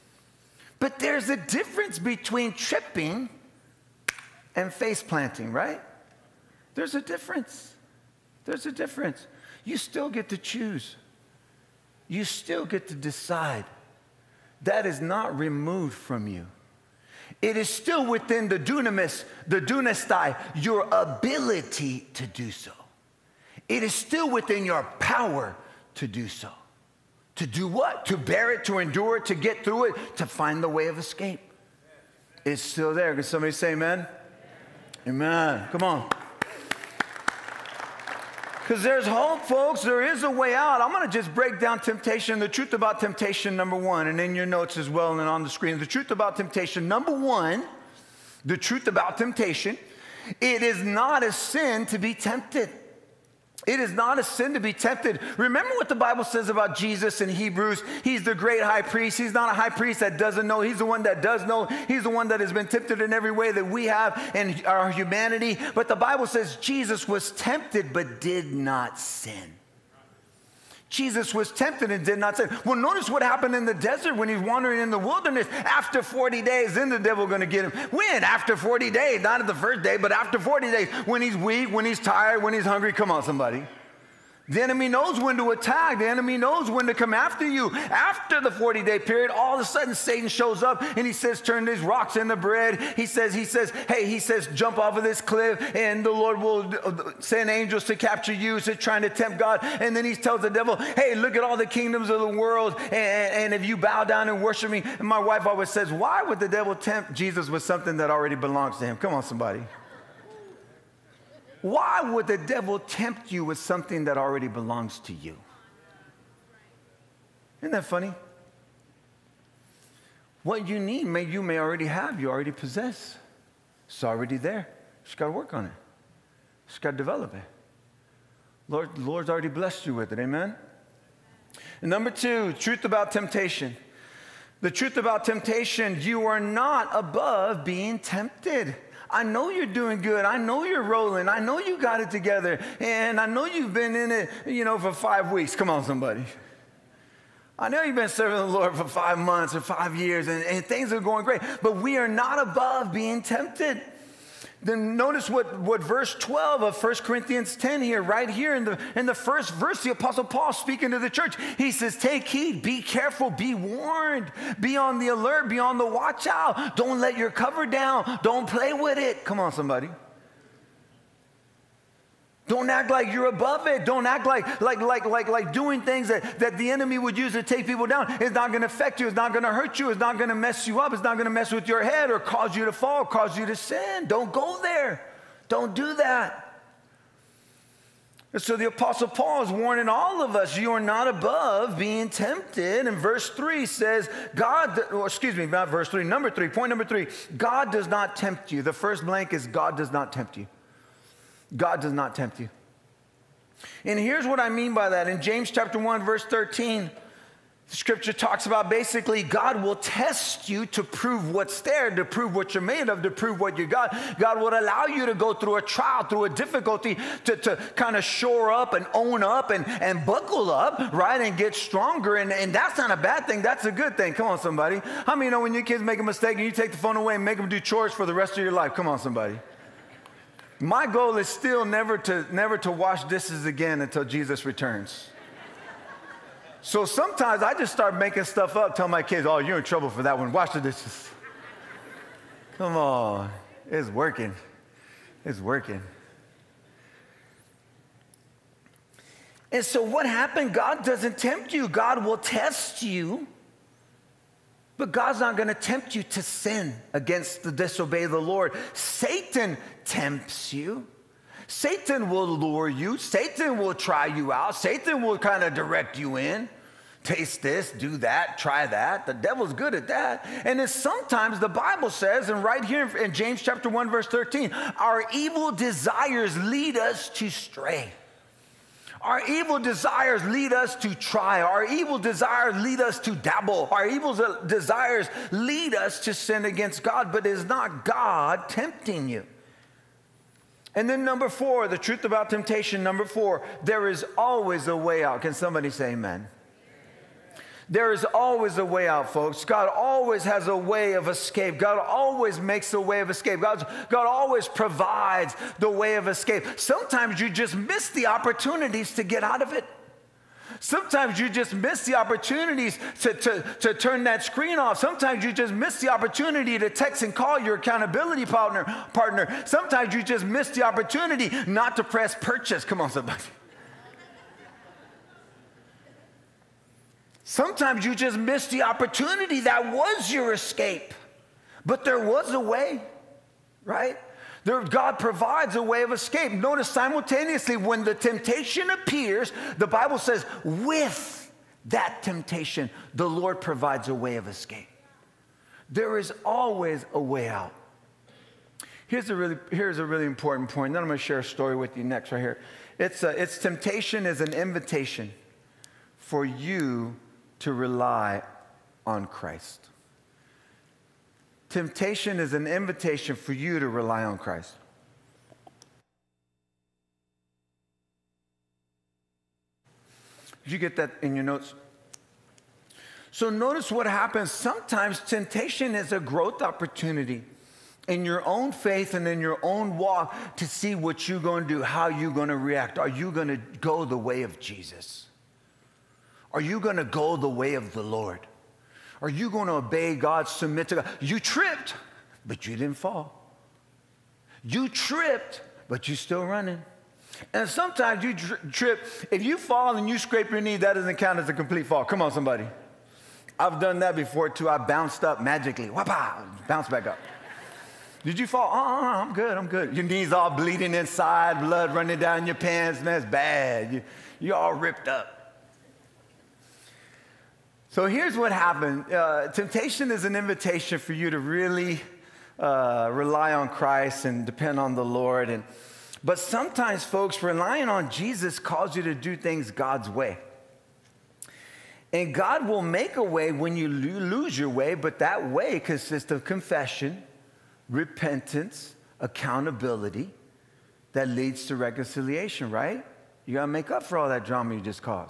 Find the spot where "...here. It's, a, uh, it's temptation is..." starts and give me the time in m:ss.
5:52.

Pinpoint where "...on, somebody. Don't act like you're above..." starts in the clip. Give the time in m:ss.
2:49.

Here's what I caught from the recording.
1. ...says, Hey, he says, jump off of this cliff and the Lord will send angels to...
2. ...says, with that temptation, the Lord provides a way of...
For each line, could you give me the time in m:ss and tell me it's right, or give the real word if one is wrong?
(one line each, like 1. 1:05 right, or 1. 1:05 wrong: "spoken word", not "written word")
1. 1:33 right
2. 5:39 right.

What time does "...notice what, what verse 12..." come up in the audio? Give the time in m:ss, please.
2:34.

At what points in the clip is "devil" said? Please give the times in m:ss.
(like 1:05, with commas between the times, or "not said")
1:16, 1:40, 1:46, 1:52, 4:29.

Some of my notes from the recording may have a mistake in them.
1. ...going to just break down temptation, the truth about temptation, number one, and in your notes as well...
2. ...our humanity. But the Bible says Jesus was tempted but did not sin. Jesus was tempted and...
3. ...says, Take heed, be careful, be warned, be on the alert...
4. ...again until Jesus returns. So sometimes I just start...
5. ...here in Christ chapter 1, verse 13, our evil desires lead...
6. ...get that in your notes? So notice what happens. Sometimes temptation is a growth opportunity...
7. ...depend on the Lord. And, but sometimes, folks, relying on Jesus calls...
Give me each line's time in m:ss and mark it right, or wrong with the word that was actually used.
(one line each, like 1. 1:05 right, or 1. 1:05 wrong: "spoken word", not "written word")
1. 0:40 right
2. 1:04 right
3. 2:41 right
4. 3:53 right
5. 4:32 wrong: "James", not "Christ"
6. 6:10 right
7. 7:04 right.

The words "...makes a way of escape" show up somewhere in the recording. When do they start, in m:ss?
5:02.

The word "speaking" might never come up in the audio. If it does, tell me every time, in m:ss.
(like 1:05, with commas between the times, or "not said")
2:40.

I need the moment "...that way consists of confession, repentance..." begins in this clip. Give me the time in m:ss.
7:14.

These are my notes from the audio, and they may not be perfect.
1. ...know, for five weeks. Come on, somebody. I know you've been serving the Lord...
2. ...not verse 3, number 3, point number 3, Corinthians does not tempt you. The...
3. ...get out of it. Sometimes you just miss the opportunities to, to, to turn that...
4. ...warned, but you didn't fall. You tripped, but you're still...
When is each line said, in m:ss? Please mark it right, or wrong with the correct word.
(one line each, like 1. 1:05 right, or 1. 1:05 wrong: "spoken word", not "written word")
1. 2:24 right
2. 3:15 wrong: "God", not "Corinthians"
3. 5:09 right
4. 6:31 wrong: "tripped", not "warned".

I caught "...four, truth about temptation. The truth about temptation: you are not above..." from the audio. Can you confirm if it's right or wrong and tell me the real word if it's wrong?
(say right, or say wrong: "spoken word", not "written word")
wrong: "two", not "four".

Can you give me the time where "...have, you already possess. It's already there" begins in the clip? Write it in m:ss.
2:01.